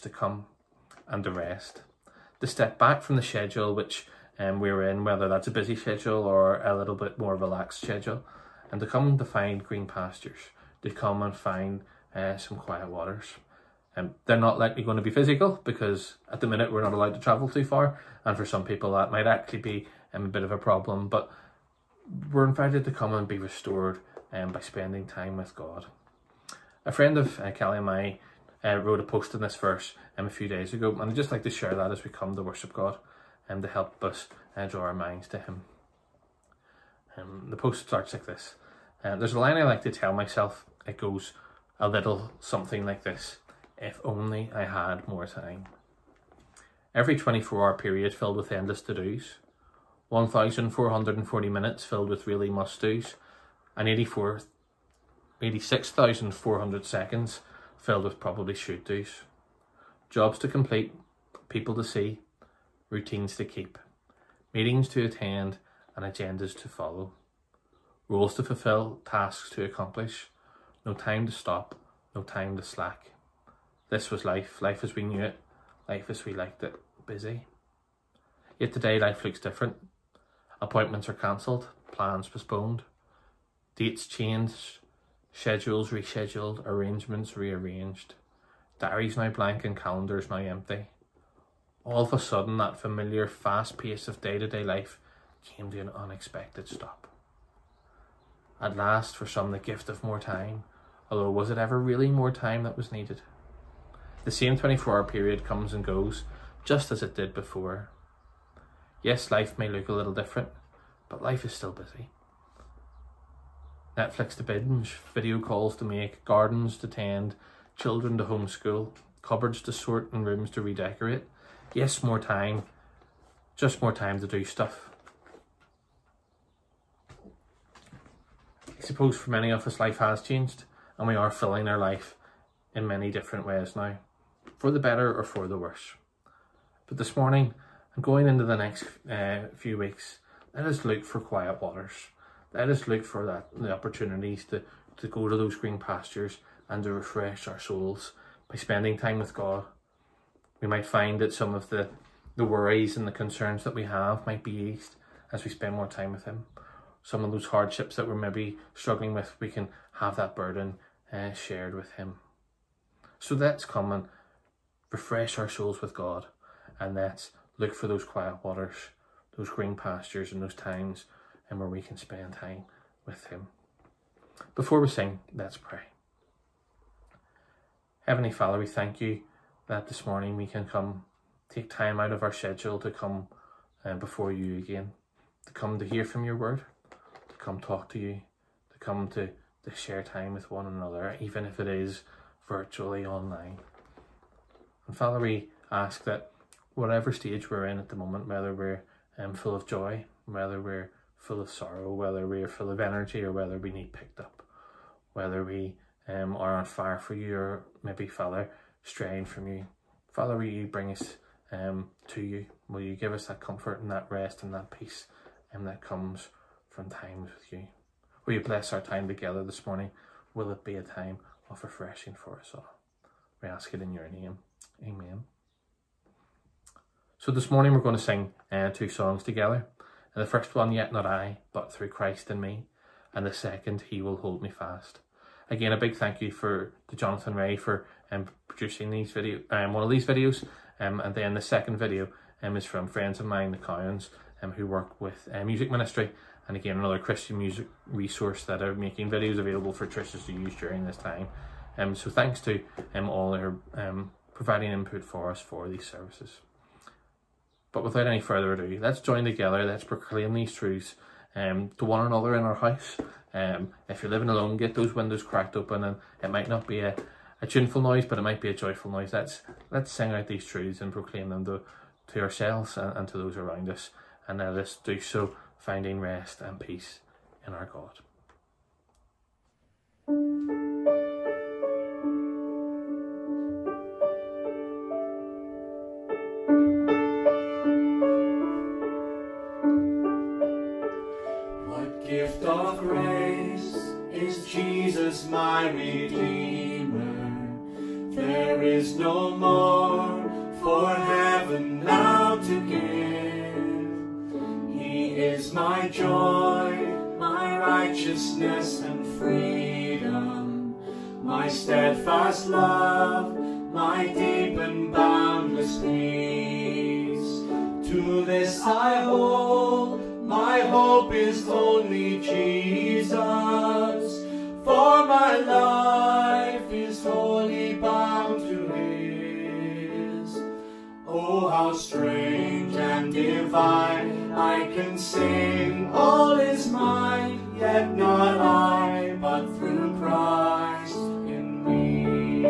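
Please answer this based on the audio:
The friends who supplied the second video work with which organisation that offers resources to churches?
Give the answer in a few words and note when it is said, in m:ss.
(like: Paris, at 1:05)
Music Ministry, at 4:05.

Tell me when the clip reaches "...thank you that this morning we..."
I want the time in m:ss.
2:58.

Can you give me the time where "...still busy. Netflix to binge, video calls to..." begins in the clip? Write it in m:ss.
1:51.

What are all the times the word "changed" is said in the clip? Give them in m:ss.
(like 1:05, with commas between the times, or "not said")
1:24, 2:10.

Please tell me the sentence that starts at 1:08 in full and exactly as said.
Roles to fulfill, tasks to accomplish, no time to stop, no time to slack.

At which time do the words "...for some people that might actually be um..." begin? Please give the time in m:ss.
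0:18.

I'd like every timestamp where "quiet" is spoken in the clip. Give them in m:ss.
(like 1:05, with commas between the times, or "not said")
0:12, 2:21, 2:48.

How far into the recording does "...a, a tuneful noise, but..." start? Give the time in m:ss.
4:26.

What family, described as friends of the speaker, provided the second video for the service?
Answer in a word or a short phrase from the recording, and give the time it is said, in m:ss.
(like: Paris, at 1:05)
The Cowans, at 4:03.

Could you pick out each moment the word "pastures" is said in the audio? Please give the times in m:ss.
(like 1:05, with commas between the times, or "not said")
0:09, 2:25, 2:49.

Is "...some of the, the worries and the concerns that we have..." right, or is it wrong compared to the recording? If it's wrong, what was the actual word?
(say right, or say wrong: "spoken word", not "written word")
right.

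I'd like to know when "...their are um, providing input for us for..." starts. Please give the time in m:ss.
4:13.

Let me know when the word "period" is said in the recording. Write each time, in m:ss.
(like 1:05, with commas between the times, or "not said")
0:47, 1:45.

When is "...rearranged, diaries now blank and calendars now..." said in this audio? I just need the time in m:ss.
1:27.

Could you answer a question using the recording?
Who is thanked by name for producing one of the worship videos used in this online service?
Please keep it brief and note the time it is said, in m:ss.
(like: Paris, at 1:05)
Jonathan Ray, at 3:56.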